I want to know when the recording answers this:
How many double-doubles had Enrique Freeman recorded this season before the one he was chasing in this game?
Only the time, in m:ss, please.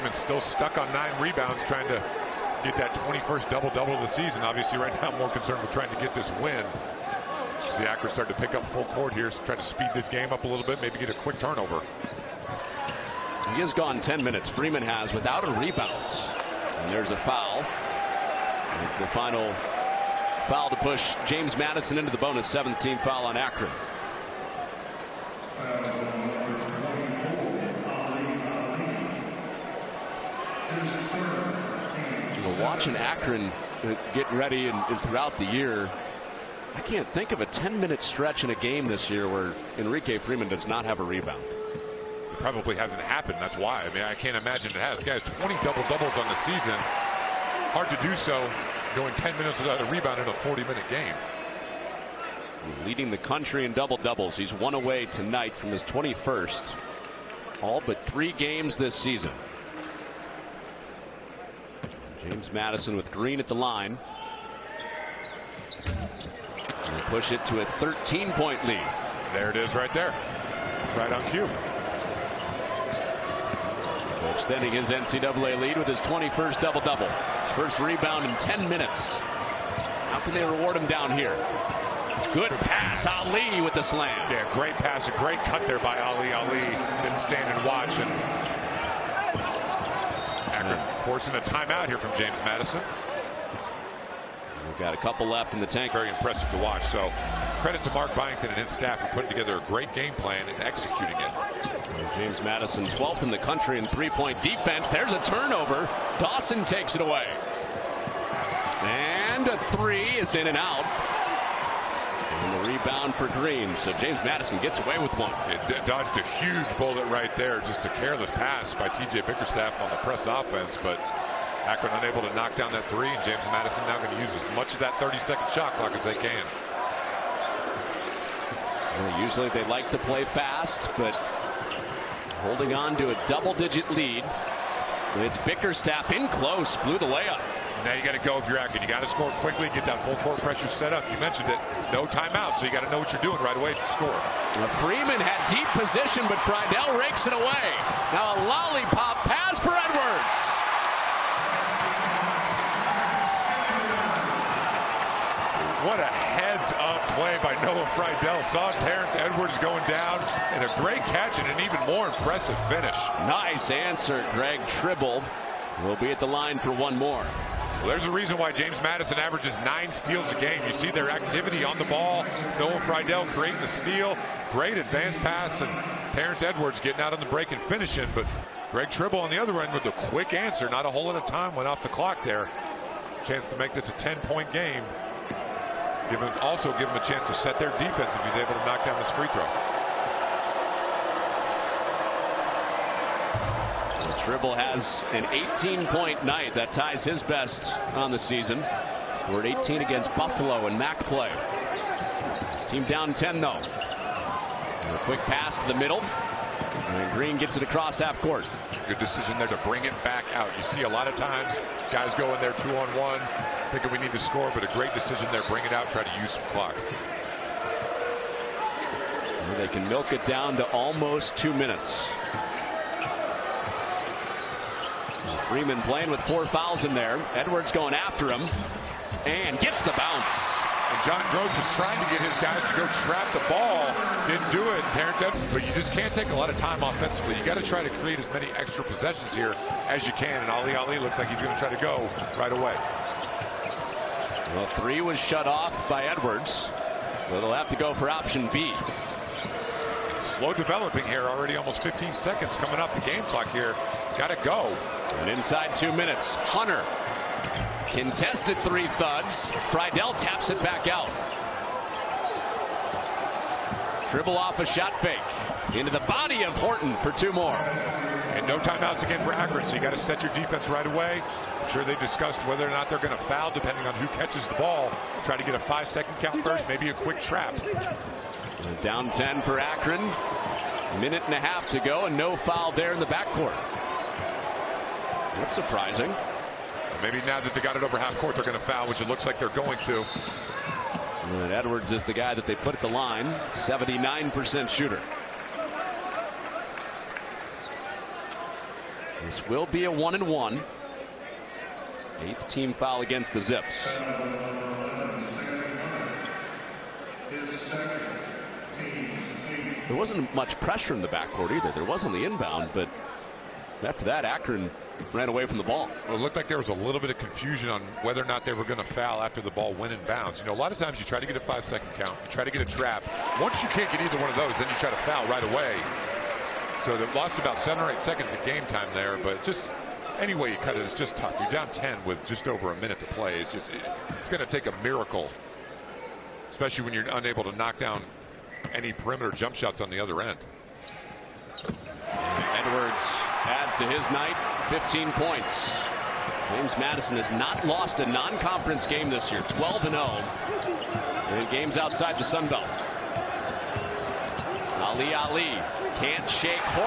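0:45.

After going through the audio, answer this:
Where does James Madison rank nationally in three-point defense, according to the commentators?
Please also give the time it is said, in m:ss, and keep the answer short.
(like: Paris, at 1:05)
12th, at 1:42.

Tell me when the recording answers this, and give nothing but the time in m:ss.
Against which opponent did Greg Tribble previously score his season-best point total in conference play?
3:20.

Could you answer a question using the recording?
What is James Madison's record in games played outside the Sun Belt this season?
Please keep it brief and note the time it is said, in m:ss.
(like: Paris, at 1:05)
12-0, at 5:49.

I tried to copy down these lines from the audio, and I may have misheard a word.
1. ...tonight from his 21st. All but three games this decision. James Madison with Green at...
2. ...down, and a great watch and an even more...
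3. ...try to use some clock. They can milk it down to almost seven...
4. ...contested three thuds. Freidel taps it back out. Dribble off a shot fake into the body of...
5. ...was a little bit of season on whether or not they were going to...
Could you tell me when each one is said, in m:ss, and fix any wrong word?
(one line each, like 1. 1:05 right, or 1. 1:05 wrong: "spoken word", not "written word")
1. 0:55 wrong: "season", not "decision"
2. 2:39 wrong: "catch", not "watch"
3. 3:35 wrong: "two", not "seven"
4. 4:17 right
5. 5:16 wrong: "confusion", not "season".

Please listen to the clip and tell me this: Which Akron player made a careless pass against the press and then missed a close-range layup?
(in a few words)
T.J. Bickerstaff.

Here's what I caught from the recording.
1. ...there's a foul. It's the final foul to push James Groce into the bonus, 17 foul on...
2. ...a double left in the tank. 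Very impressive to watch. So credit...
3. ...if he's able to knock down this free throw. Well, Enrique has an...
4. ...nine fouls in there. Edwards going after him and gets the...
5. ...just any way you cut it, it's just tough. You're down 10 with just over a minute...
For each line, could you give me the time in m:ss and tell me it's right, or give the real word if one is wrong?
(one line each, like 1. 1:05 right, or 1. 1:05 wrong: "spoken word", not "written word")
1. 0:16 wrong: "Madison", not "Groce"
2. 1:34 wrong: "couple", not "double"
3. 3:08 wrong: "Tribble", not "Enrique"
4. 3:46 wrong: "four", not "nine"
5. 5:29 right.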